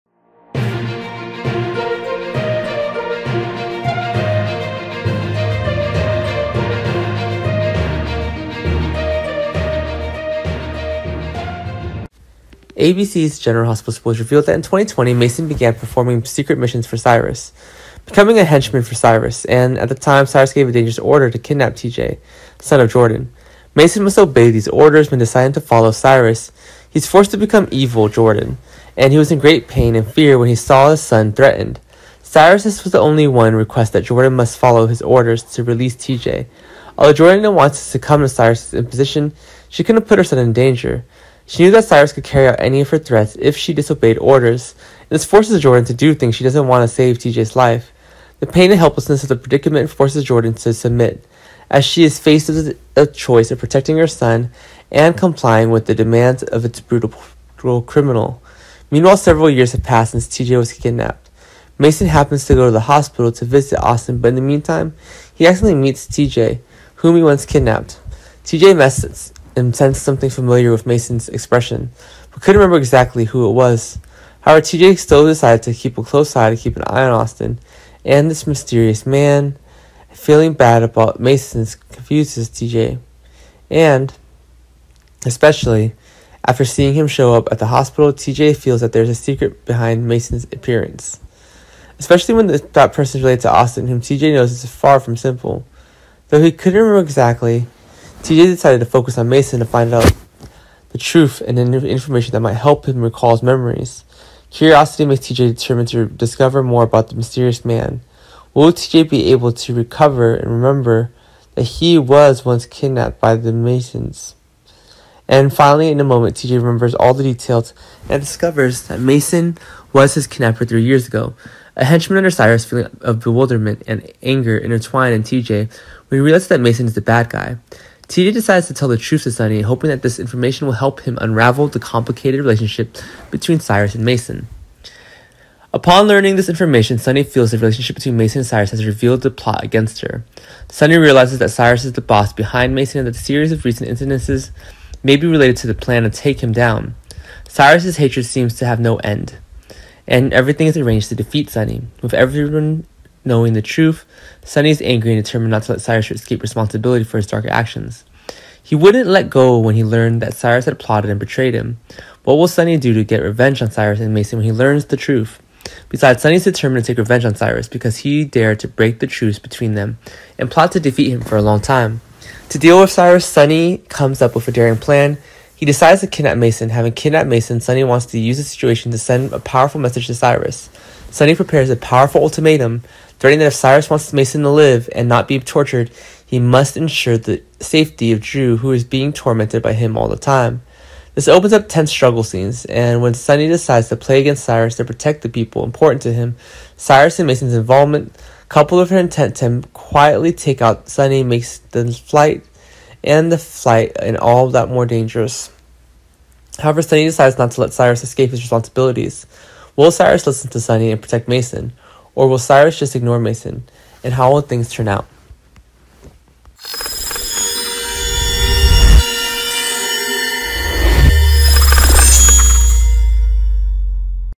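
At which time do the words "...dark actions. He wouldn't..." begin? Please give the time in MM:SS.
02:37.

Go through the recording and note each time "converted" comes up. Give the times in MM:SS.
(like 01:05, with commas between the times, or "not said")
not said.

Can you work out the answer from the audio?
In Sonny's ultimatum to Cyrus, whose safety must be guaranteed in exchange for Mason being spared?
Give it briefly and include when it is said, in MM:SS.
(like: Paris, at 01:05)
Drew, at 03:08.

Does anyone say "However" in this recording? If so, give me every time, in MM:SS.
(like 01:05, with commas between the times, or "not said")
01:14, 03:26.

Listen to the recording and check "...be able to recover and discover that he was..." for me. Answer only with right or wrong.
wrong.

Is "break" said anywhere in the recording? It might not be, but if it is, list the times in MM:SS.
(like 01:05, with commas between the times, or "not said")
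02:48.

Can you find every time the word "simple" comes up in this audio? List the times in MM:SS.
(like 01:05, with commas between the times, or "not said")
01:35.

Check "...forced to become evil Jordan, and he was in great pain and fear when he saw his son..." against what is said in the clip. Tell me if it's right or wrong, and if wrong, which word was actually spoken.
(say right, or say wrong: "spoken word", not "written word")
right.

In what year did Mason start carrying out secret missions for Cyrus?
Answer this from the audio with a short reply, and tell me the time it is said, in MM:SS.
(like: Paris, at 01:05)
2020, at 00:14.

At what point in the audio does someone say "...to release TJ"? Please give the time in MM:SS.
00:35.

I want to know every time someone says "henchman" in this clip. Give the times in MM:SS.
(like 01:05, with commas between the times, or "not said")
00:18, 02:01.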